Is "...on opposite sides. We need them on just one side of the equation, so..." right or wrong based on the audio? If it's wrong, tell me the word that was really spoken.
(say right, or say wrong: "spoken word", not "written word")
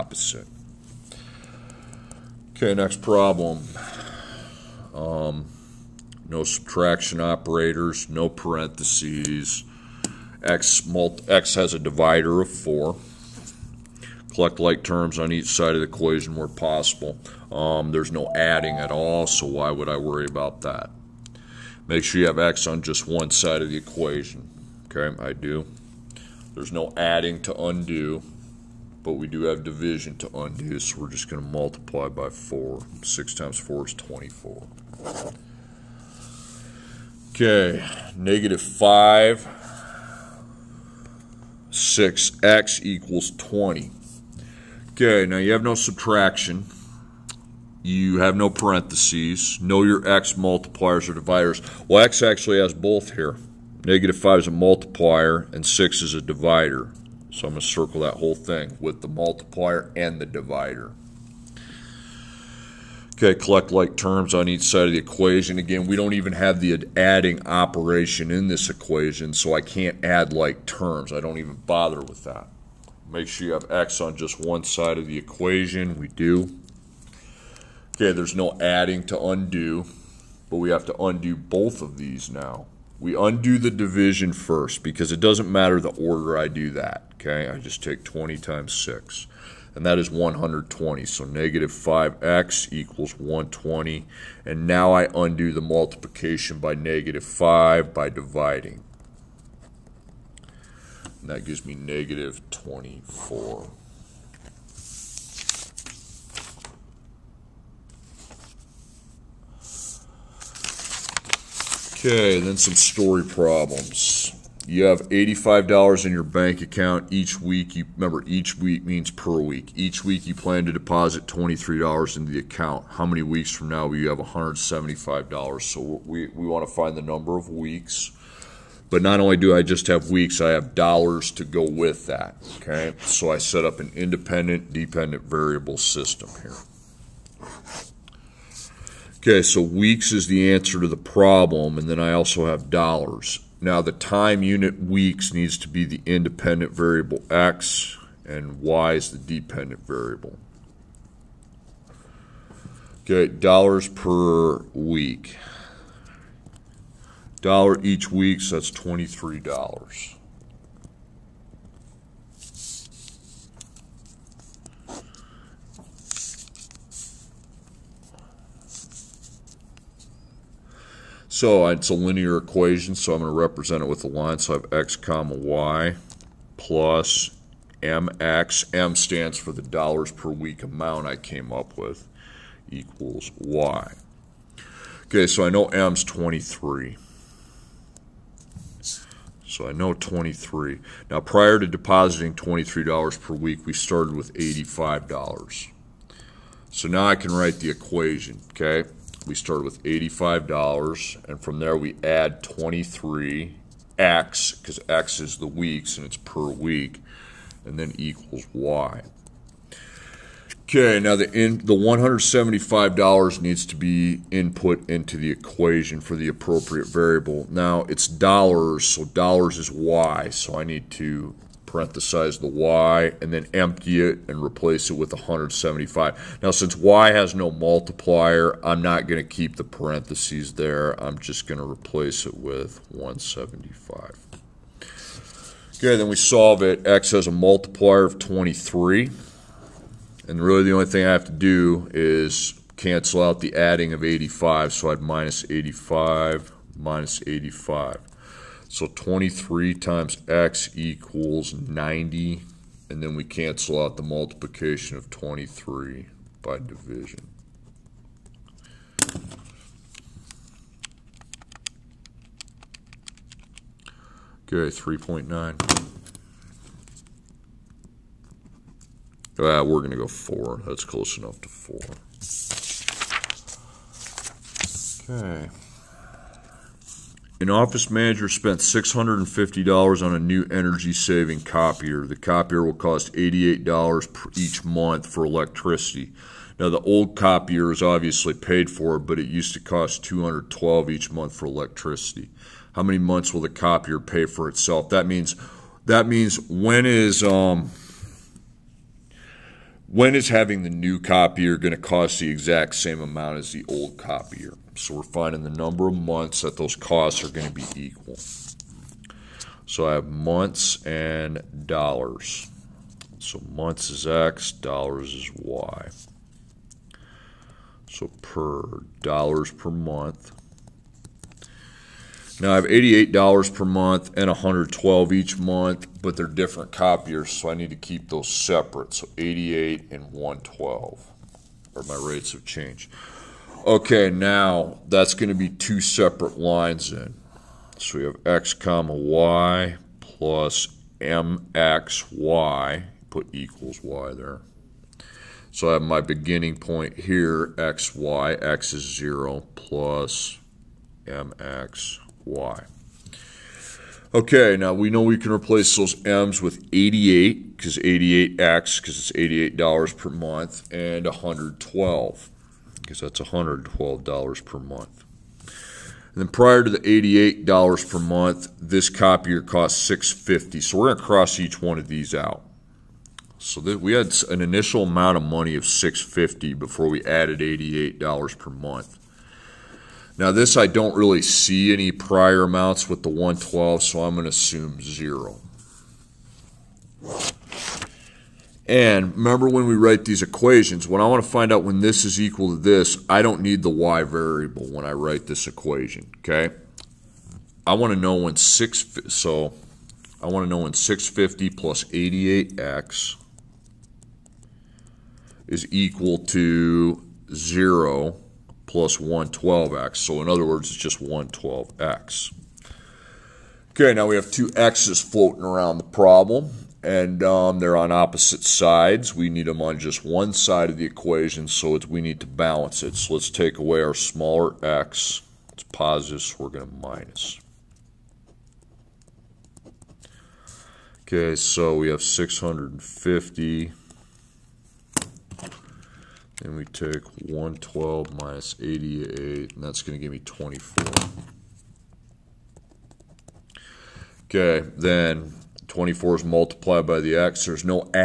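right.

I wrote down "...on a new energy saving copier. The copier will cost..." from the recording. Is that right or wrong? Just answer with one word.
right.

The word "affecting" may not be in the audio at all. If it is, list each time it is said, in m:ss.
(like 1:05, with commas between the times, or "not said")
not said.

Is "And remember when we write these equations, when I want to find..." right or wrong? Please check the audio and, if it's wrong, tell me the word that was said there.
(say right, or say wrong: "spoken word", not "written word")
right.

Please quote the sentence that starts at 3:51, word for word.
I'm just going to replace it with 175.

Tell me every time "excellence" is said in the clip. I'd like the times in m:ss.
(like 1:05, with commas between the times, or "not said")
not said.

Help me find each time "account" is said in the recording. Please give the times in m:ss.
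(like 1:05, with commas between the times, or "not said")
1:56, 2:02.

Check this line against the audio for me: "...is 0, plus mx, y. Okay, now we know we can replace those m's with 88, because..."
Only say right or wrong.
right.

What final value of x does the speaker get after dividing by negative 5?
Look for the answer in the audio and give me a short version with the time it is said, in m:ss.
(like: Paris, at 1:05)
-24, at 1:41.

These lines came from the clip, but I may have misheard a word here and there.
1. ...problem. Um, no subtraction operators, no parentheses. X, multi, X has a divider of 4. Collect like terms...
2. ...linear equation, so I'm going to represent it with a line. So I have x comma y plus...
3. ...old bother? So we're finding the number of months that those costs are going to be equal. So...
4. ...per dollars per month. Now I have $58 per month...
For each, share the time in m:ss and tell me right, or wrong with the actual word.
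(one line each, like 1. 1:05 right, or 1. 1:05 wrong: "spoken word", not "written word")
1. 0:03 right
2. 2:51 right
3. 5:03 wrong: "copier", not "bother"
4. 5:18 wrong: "88", not "58".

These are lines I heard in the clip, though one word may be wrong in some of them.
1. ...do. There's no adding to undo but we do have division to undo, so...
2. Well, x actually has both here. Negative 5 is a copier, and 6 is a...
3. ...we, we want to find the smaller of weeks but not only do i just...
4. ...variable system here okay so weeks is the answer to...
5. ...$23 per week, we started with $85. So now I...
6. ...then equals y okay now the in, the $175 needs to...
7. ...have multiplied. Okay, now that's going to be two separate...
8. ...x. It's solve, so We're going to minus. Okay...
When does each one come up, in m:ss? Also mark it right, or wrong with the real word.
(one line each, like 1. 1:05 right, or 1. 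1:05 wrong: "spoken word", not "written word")
1. 0:25 right
2. 0:51 wrong: "multiplier", not "copier"
3. 2:06 wrong: "number", not "smaller"
4. 2:15 right
5. 3:12 right
6. 3:27 right
7. 5:32 wrong: "changed", not "multiplied"
8. 7:04 wrong: "positive", not "solve".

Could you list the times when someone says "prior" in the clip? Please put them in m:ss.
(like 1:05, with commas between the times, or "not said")
3:11, 6:06, 6:21.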